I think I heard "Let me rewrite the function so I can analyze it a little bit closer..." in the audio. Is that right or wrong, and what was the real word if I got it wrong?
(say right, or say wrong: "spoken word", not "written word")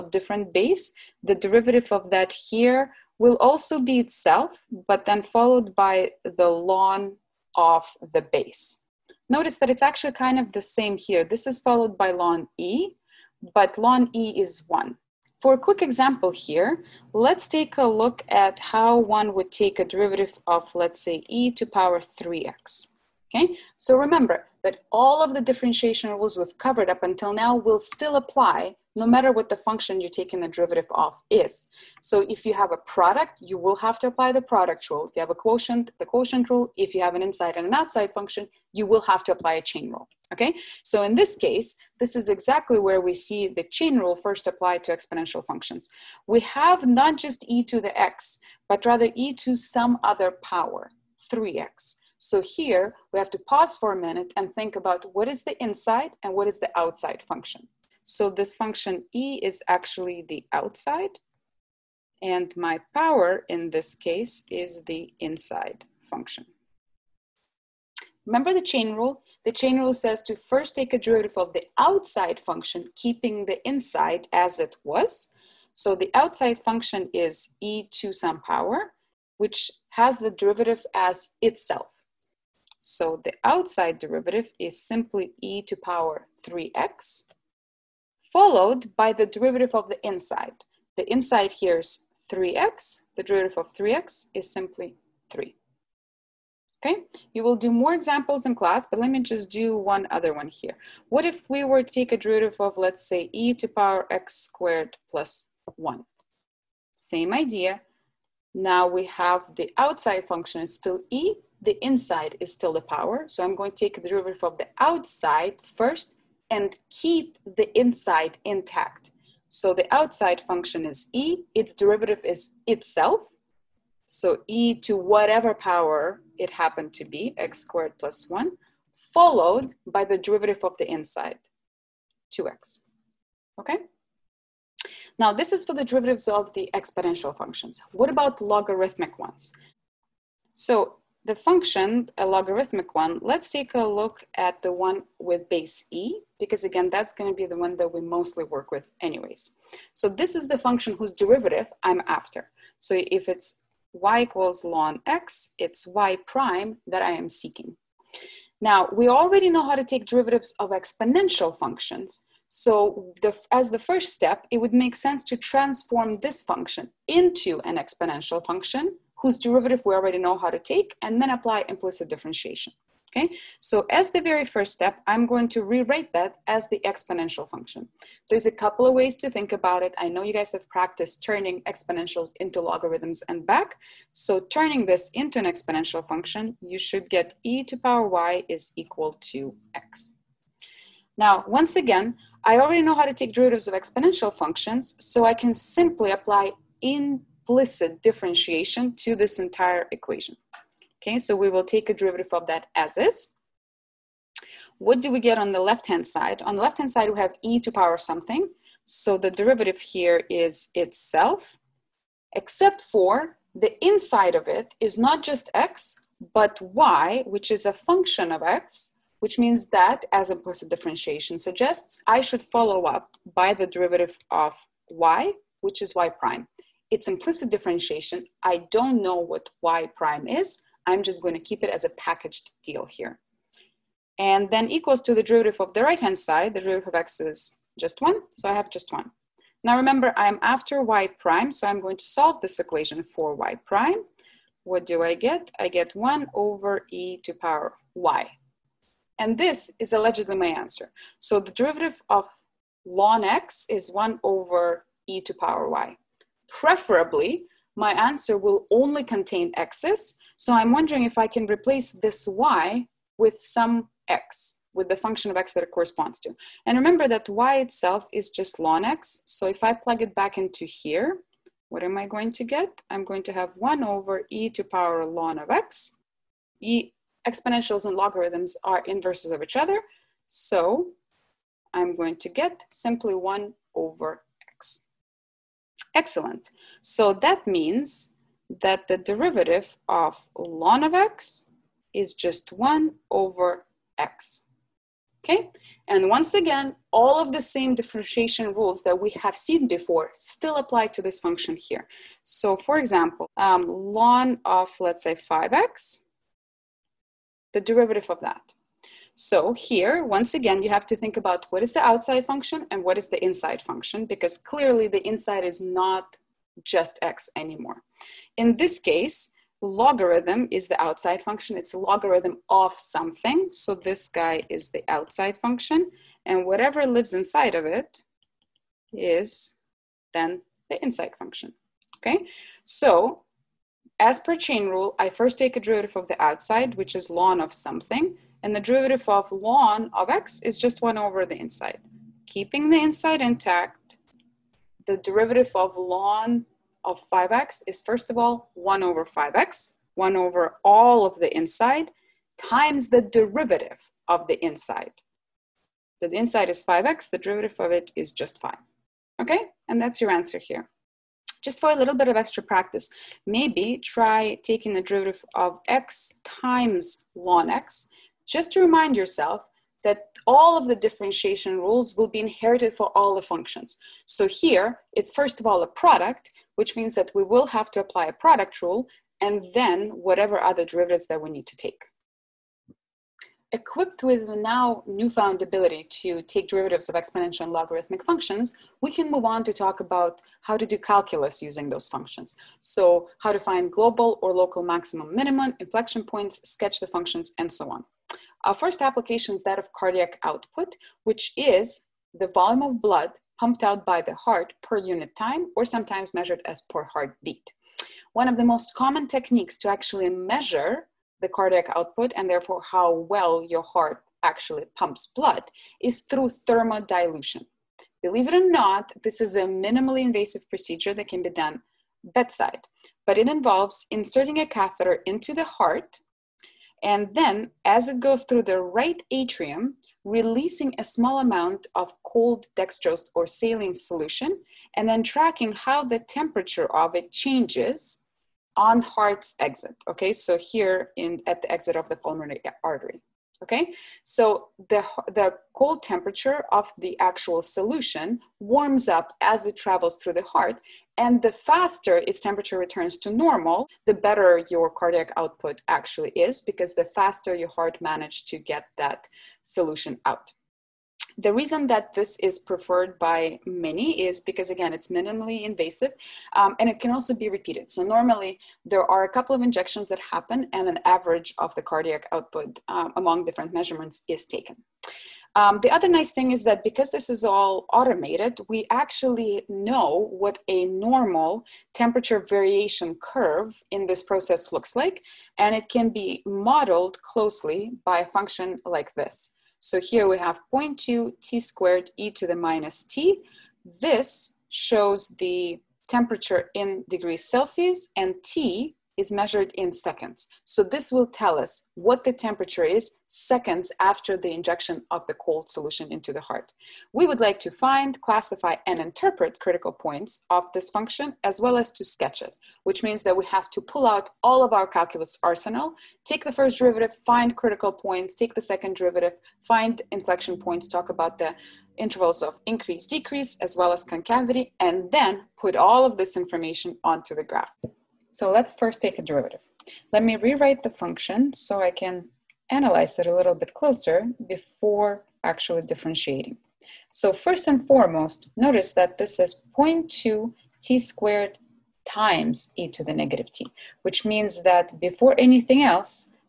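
right.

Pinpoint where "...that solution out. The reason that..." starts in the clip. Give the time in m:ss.
7:38.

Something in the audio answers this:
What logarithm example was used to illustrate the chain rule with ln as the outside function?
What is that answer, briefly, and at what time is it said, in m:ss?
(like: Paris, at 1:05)
ln of 5x, at 5:03.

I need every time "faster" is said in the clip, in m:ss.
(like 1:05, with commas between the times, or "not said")
7:31, 7:36.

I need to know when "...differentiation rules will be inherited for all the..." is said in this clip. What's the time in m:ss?
6:10.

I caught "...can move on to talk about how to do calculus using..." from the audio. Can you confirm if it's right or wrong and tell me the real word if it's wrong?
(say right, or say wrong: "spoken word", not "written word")
right.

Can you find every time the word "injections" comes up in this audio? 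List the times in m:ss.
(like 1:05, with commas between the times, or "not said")
7:49, 8:24.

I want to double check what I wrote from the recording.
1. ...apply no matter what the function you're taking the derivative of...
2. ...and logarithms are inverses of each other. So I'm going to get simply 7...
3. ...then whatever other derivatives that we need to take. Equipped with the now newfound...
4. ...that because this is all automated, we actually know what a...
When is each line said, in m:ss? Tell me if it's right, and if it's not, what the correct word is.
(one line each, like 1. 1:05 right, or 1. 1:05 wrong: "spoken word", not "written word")
1. 0:28 right
2. 4:37 wrong: "1", not "7"
3. 6:19 right
4. 7:56 right.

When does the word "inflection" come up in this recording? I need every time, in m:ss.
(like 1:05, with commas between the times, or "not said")
6:35, 8:39.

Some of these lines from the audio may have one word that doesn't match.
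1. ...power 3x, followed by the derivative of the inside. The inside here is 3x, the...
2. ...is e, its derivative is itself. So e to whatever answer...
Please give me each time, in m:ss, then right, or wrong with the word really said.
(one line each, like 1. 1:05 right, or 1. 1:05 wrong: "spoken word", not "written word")
1. 1:25 right
2. 2:00 wrong: "power", not "answer".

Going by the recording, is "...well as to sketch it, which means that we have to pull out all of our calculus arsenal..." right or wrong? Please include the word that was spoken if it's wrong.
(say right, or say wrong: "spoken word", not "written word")
right.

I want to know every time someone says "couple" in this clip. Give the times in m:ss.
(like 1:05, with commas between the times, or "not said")
2:58, 7:49.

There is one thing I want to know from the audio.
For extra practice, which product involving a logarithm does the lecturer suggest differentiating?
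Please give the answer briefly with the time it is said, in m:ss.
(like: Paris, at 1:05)
x times ln x, at 6:05.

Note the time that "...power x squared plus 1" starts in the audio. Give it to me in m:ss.
1:43.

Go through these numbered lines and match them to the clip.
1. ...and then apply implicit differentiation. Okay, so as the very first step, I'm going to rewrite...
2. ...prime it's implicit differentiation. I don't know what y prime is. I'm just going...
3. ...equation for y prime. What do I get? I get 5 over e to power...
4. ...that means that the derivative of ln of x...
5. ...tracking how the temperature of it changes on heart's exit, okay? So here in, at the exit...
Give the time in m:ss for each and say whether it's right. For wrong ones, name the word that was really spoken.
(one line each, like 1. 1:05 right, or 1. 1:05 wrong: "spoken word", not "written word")
1. 2:51 right
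2. 3:46 right
3. 4:02 wrong: "1", not "5"
4. 4:47 right
5. 7:15 right.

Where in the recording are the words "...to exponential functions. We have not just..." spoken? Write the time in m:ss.
0:44.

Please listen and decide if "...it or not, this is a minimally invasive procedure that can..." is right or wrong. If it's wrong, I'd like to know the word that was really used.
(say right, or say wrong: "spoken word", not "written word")
right.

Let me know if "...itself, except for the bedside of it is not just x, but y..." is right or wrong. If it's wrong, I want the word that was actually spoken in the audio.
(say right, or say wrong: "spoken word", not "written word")
wrong: "inside", not "bedside".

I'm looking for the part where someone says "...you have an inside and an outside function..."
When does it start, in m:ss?
0:36.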